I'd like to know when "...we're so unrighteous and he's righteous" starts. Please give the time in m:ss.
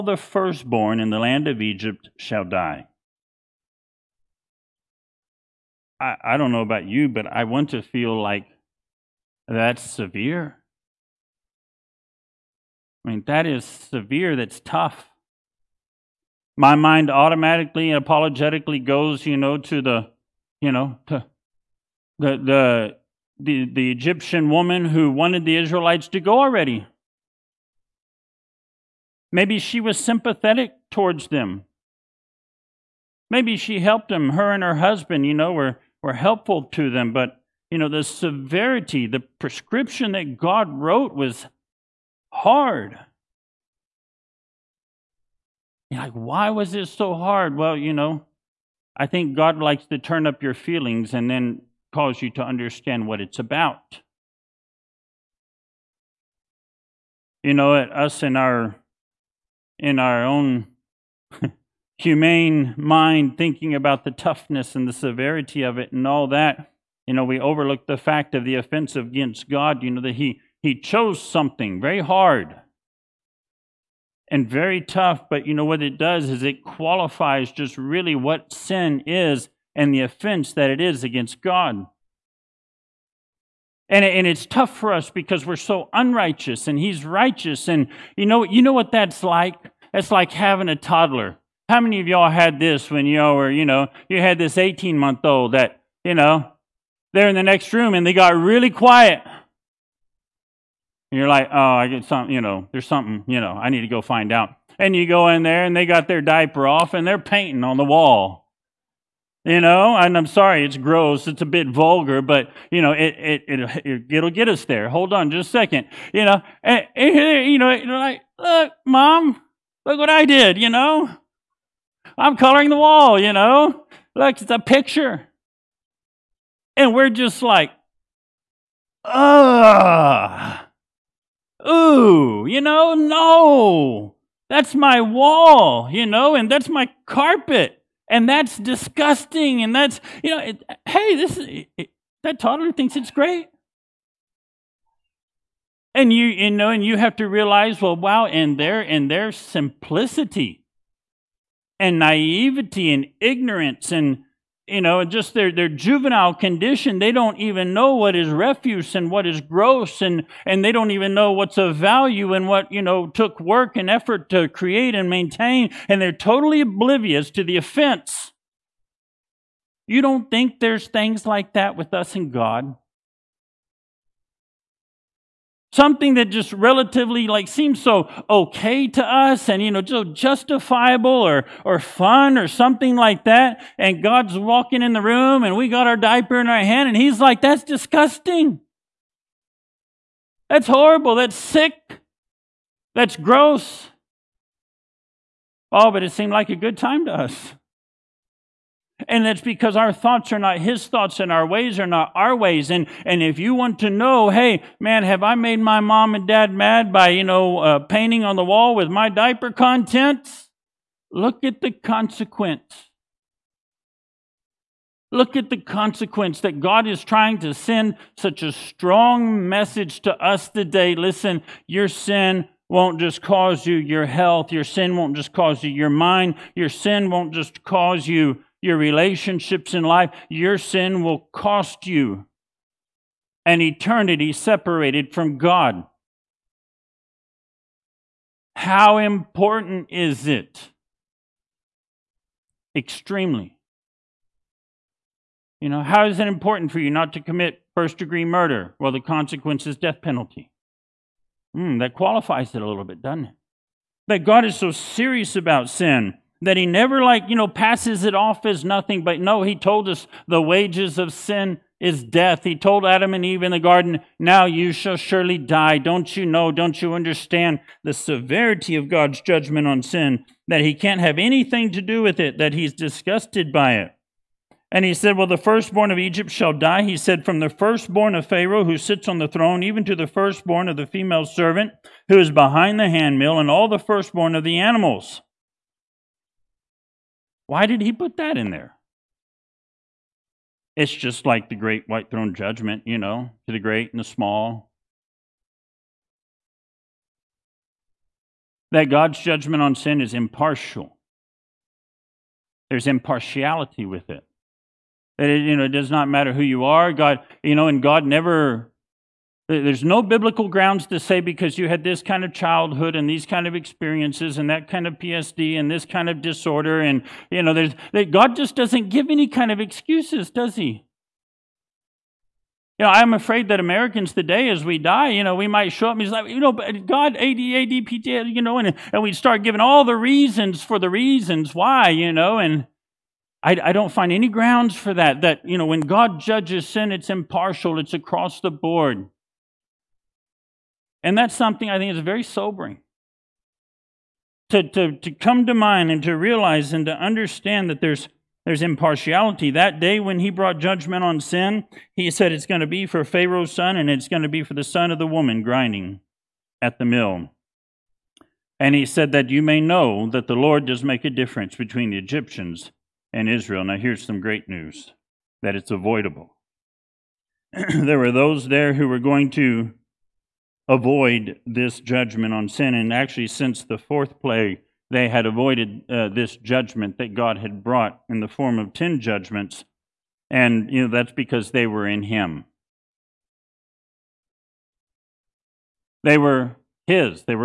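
1:25.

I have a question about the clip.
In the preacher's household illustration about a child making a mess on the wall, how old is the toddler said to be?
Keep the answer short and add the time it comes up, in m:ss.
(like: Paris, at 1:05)
18 months, at 1:34.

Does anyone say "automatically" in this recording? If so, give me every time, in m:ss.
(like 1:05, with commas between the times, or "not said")
0:17.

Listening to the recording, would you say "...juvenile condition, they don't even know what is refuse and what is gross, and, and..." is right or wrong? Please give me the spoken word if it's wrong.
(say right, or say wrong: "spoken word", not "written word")
right.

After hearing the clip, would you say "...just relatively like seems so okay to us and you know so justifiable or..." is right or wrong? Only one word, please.
right.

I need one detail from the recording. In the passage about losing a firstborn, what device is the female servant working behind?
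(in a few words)
the handmill.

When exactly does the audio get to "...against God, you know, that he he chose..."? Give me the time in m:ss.
1:08.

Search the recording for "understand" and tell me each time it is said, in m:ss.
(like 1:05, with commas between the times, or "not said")
0:52, 4:26, 5:46.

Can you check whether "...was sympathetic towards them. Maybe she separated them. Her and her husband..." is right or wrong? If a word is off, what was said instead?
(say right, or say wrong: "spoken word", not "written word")
wrong: "helped", not "separated".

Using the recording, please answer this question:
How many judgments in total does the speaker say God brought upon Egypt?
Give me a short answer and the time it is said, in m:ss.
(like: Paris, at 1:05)
10, at 6:18.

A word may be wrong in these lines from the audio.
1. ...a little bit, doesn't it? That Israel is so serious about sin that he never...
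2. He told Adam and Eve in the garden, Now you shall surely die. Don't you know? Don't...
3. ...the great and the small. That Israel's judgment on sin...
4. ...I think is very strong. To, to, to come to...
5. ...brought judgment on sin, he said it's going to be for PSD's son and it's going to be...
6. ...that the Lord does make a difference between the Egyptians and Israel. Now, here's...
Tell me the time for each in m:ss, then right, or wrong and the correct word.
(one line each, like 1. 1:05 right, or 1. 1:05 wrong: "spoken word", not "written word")
1. 4:12 wrong: "God", not "Israel"
2. 4:22 right
3. 4:53 wrong: "God", not "Israel"
4. 5:41 wrong: "sobering", not "strong"
5. 5:50 wrong: "Pharaoh", not "PSD"
6. 6:00 right.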